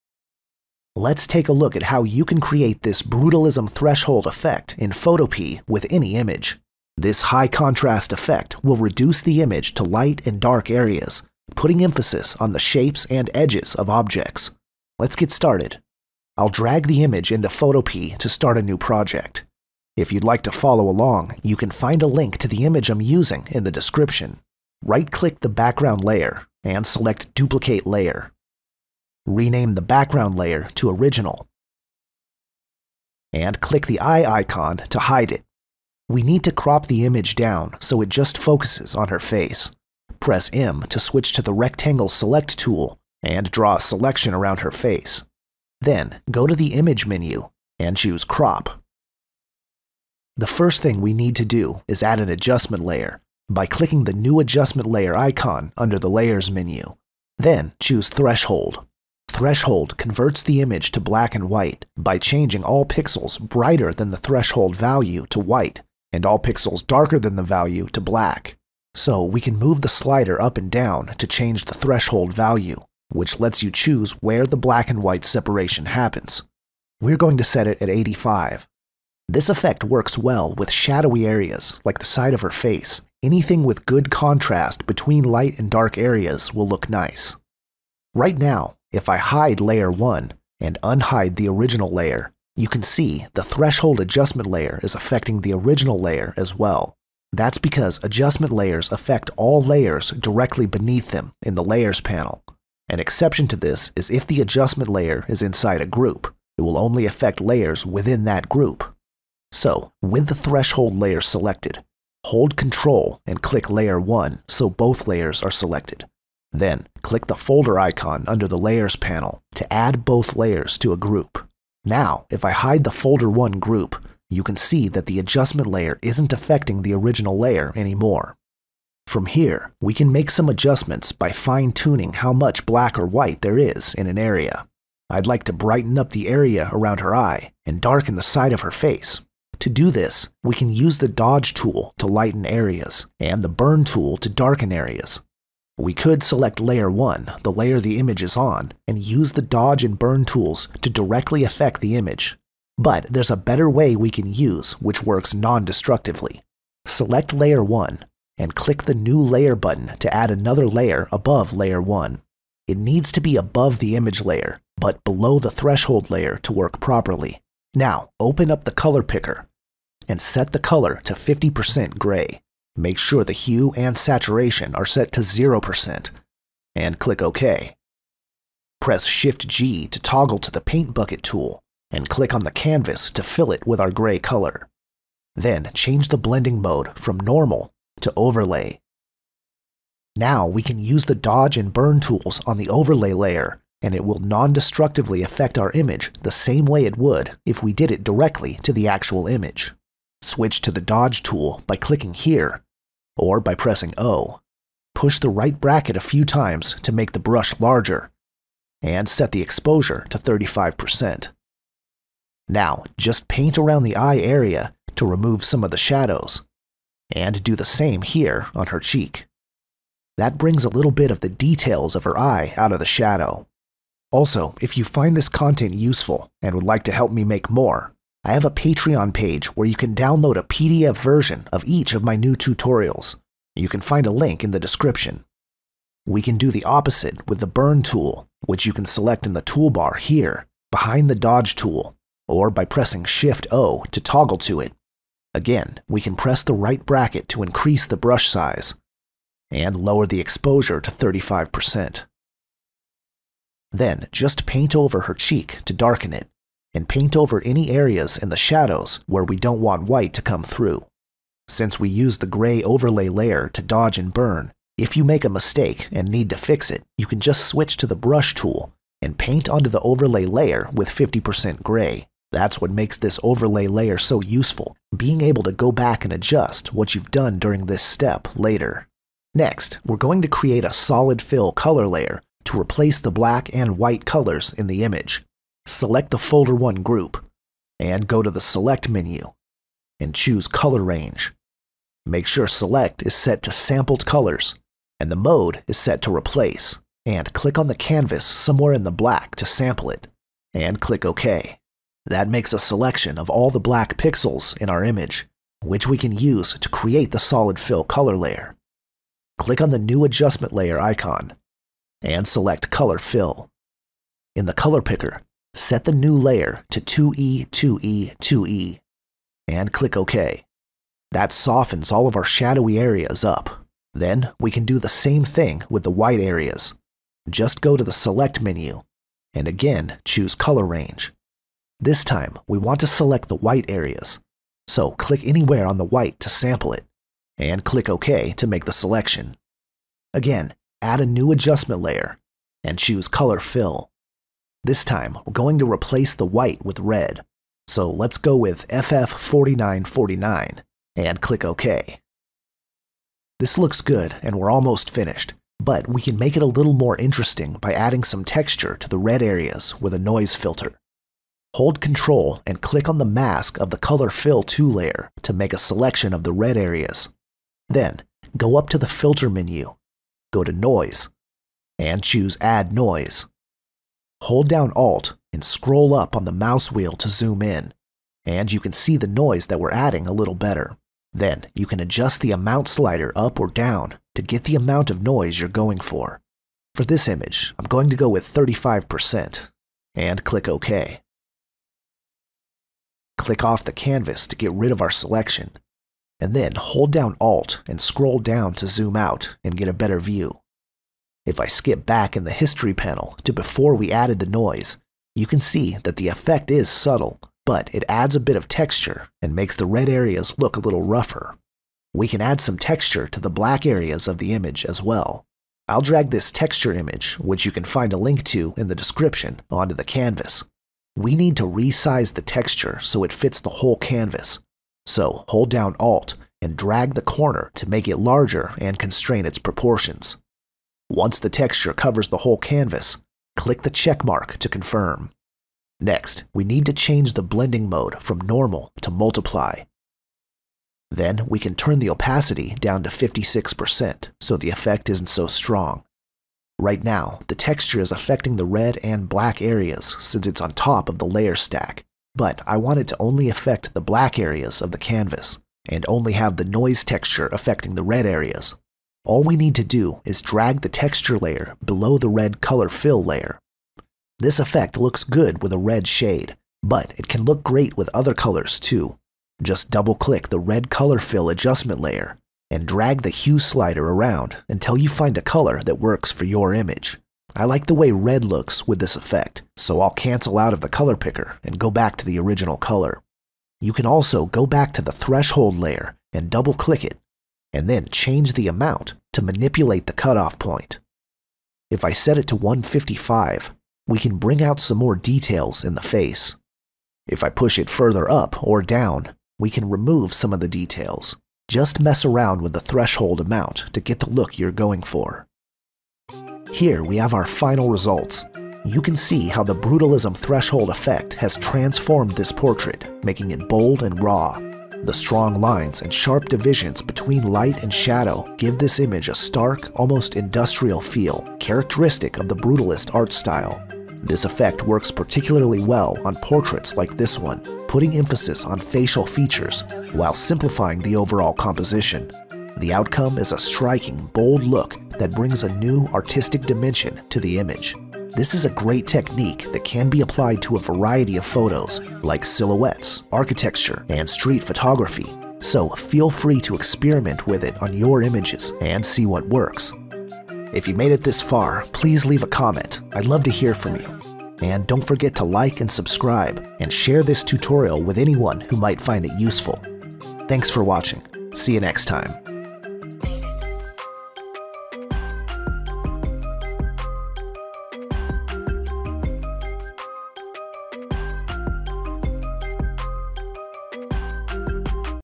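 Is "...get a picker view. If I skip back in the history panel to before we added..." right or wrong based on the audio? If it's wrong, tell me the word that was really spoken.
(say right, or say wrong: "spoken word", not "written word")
wrong: "better", not "picker".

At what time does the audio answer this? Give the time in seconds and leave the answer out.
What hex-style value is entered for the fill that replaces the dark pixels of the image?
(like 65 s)
316 s.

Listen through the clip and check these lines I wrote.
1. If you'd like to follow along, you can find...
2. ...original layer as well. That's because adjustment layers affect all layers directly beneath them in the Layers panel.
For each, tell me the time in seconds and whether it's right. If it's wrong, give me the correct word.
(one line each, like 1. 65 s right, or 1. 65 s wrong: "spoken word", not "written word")
1. 19 s right
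2. 95 s right.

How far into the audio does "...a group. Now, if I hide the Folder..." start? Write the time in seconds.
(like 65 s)
120 s.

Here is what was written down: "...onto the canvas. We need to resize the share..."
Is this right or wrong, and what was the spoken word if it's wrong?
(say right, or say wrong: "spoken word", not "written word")
wrong: "texture", not "share".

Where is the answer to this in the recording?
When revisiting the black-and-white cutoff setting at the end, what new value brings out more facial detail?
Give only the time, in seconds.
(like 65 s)
492 s.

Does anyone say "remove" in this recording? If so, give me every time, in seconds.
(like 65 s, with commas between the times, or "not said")
215 s, 499 s.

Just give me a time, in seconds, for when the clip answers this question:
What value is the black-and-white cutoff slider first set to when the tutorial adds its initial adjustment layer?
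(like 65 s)
77 s.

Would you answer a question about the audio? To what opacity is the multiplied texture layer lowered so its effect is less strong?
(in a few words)
56%.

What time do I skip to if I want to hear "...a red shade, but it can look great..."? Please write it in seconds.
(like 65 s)
465 s.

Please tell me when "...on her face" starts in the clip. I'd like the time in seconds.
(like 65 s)
38 s.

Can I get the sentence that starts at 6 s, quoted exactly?
This high contrast effect will reduce the image to light and dark areas, putting emphasis on the shapes and edges of objects.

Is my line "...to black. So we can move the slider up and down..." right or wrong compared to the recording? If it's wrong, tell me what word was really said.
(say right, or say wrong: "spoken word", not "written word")
right.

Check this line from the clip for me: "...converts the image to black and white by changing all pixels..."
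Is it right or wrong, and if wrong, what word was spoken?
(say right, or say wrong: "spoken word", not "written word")
right.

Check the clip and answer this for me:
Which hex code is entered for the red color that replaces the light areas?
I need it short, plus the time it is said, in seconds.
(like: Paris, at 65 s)
FF4949, at 348 s.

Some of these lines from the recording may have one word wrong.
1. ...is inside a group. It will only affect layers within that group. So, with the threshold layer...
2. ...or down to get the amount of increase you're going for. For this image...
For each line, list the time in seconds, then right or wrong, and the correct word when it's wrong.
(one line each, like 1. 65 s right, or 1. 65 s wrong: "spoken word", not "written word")
1. 105 s right
2. 383 s wrong: "noise", not "increase".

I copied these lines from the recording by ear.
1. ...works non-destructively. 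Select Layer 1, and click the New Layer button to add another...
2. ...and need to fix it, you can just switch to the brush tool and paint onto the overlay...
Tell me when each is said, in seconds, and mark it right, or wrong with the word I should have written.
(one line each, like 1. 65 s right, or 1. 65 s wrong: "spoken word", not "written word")
1. 155 s right
2. 265 s right.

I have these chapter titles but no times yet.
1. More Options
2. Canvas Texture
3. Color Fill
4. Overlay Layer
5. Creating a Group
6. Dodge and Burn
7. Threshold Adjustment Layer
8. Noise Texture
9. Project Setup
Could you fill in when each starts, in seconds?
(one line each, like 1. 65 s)
1. 463 s
2. 411 s
3. 279 s
4. 128 s
5. 87 s
6. 200 s
7. 49 s
8. 352 s
9. 16 s.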